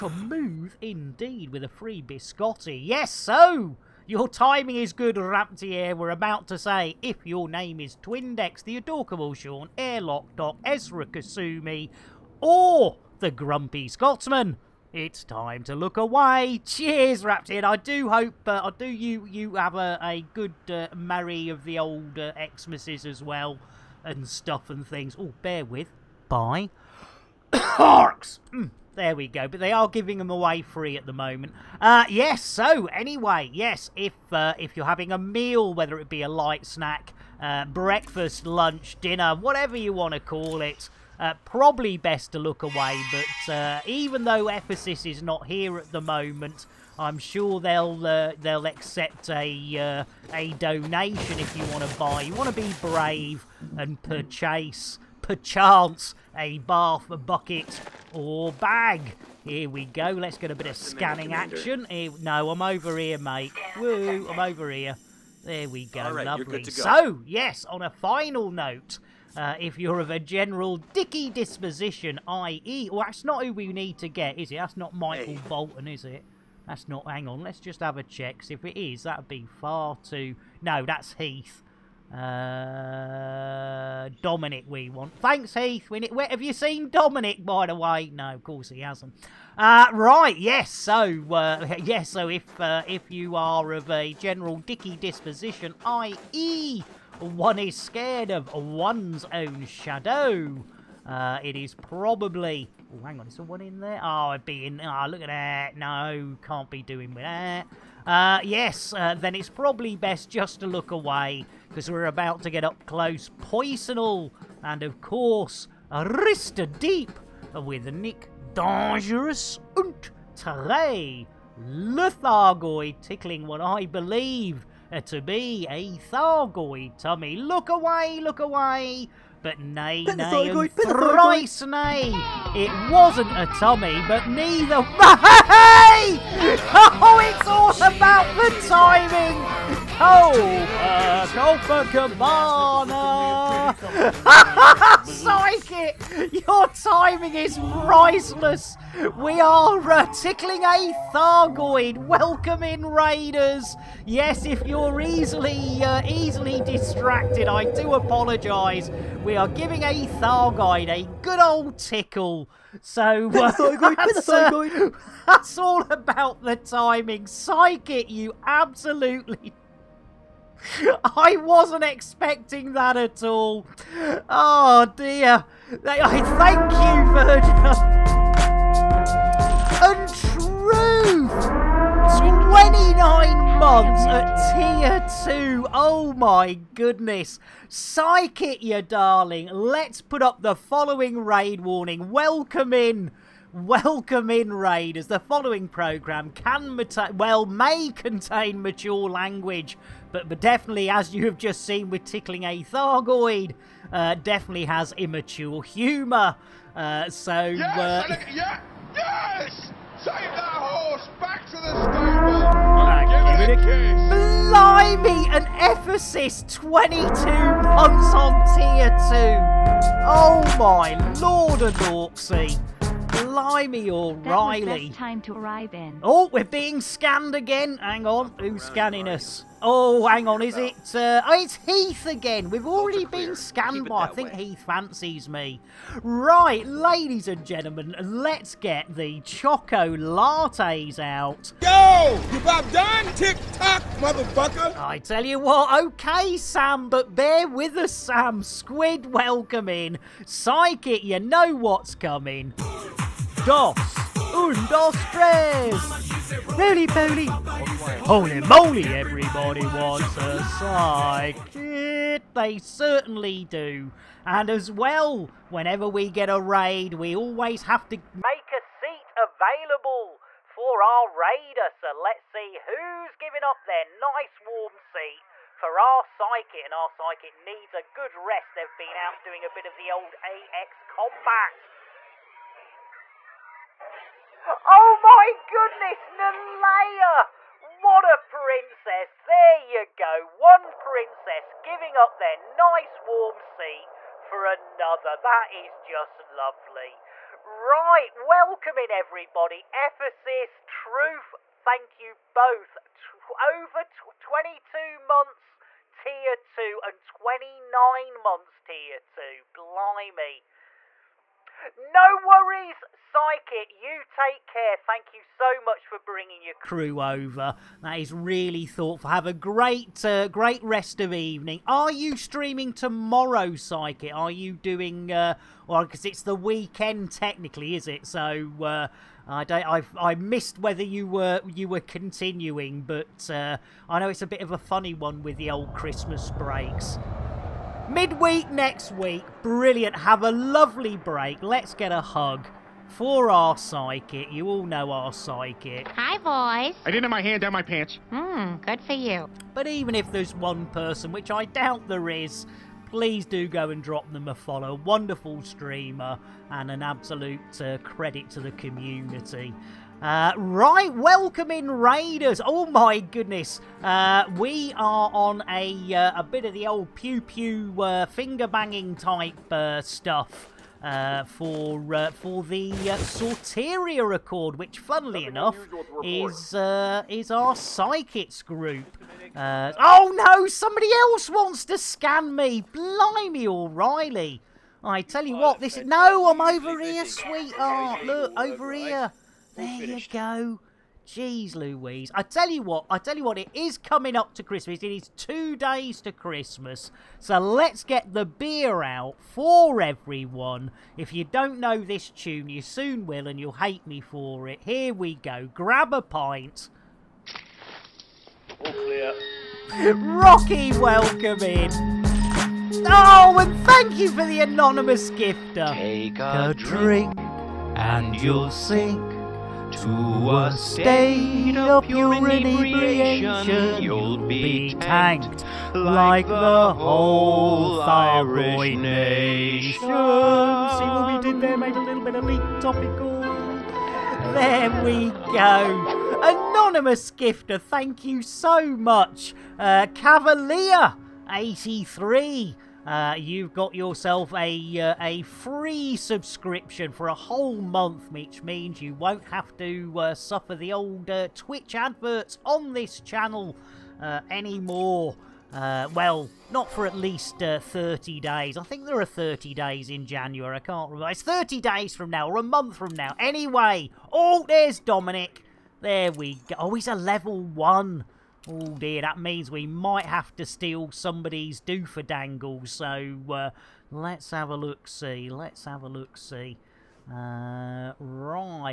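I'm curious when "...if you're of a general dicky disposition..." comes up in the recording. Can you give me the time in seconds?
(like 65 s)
69 s.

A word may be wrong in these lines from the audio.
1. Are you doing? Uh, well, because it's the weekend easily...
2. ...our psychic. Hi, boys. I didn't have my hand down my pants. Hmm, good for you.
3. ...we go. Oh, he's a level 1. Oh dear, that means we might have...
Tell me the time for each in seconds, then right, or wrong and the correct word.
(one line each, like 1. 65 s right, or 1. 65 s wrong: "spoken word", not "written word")
1. 324 s wrong: "technically", not "easily"
2. 344 s right
3. 466 s right.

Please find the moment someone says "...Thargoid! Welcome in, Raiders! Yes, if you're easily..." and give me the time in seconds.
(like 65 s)
151 s.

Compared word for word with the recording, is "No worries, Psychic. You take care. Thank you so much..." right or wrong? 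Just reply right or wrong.
right.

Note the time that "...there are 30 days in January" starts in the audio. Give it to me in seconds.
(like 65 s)
458 s.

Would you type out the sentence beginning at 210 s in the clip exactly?
Take that horse back to the stable.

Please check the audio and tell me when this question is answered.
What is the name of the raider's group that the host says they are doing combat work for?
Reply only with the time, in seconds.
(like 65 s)
372 s.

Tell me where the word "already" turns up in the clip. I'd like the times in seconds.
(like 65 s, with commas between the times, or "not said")
232 s.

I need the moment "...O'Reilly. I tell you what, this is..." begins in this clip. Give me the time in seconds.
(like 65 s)
383 s.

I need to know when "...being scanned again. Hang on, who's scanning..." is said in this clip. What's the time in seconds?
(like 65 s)
226 s.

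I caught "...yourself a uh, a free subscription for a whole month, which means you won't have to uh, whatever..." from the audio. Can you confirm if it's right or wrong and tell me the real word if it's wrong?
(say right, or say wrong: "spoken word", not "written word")
wrong: "suffer", not "whatever".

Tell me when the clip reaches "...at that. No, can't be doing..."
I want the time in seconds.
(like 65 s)
105 s.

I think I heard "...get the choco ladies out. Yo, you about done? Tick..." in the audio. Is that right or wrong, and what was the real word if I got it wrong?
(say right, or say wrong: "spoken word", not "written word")
wrong: "lattes", not "ladies".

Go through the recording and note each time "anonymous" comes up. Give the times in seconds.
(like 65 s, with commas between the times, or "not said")
414 s, 436 s.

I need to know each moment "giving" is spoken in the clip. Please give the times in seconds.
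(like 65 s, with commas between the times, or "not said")
29 s, 159 s, 273 s, 291 s.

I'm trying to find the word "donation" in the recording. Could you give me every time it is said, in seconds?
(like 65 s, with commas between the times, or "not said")
50 s.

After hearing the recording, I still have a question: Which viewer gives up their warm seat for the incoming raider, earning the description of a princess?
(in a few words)
Nalaya.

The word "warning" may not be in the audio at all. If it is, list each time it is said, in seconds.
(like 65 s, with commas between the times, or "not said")
191 s.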